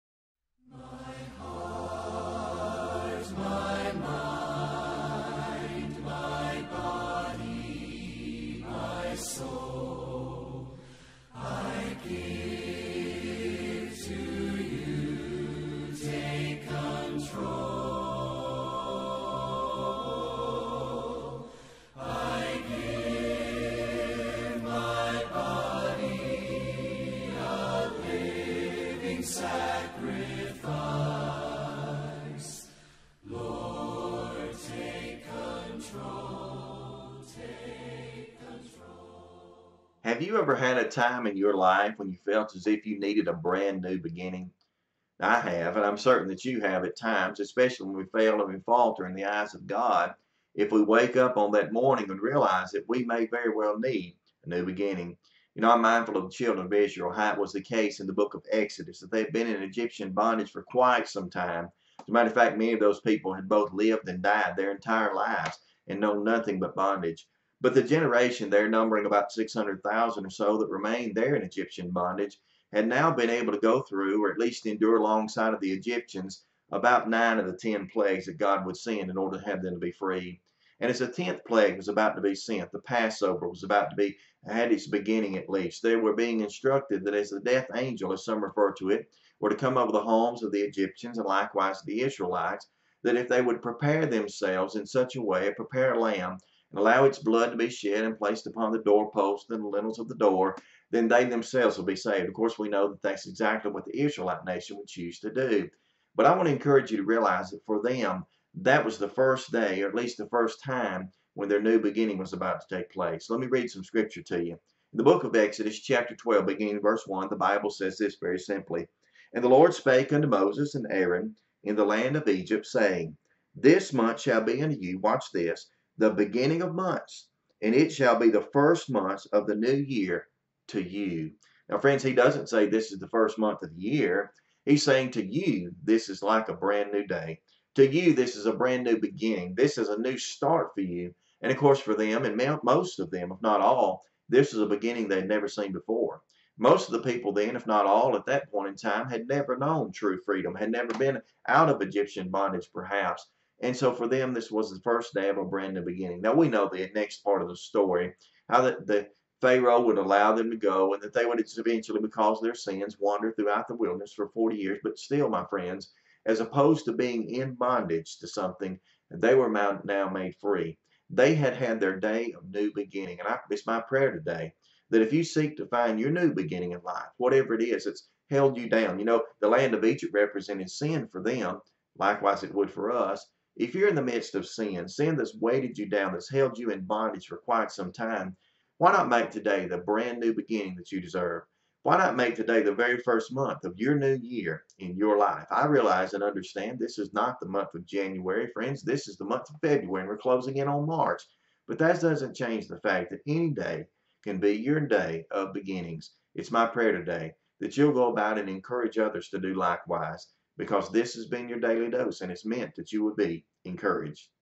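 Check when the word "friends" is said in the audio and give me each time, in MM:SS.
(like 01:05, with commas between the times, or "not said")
02:11, 02:45, 03:18.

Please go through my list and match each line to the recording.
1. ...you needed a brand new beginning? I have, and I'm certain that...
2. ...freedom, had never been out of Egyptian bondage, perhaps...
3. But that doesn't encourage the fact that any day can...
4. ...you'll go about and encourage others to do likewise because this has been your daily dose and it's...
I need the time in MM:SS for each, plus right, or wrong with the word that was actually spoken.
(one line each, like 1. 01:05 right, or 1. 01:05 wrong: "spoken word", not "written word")
1. 00:42 right
2. 02:30 right
3. 03:21 wrong: "change", not "encourage"
4. 03:27 right.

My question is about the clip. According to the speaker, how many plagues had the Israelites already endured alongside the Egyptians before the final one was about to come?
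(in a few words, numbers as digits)
9.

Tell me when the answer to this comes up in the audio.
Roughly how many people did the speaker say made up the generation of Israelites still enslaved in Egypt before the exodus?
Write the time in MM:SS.
01:09.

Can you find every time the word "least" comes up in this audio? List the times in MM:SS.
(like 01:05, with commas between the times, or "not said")
01:14, 01:25, 01:49.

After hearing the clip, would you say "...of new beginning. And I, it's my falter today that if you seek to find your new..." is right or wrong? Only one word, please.
wrong.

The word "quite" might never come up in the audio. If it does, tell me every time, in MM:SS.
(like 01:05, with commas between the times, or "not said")
01:00, 03:07.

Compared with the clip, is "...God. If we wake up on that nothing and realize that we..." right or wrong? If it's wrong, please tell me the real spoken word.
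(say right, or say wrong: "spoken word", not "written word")
wrong: "morning", not "nothing".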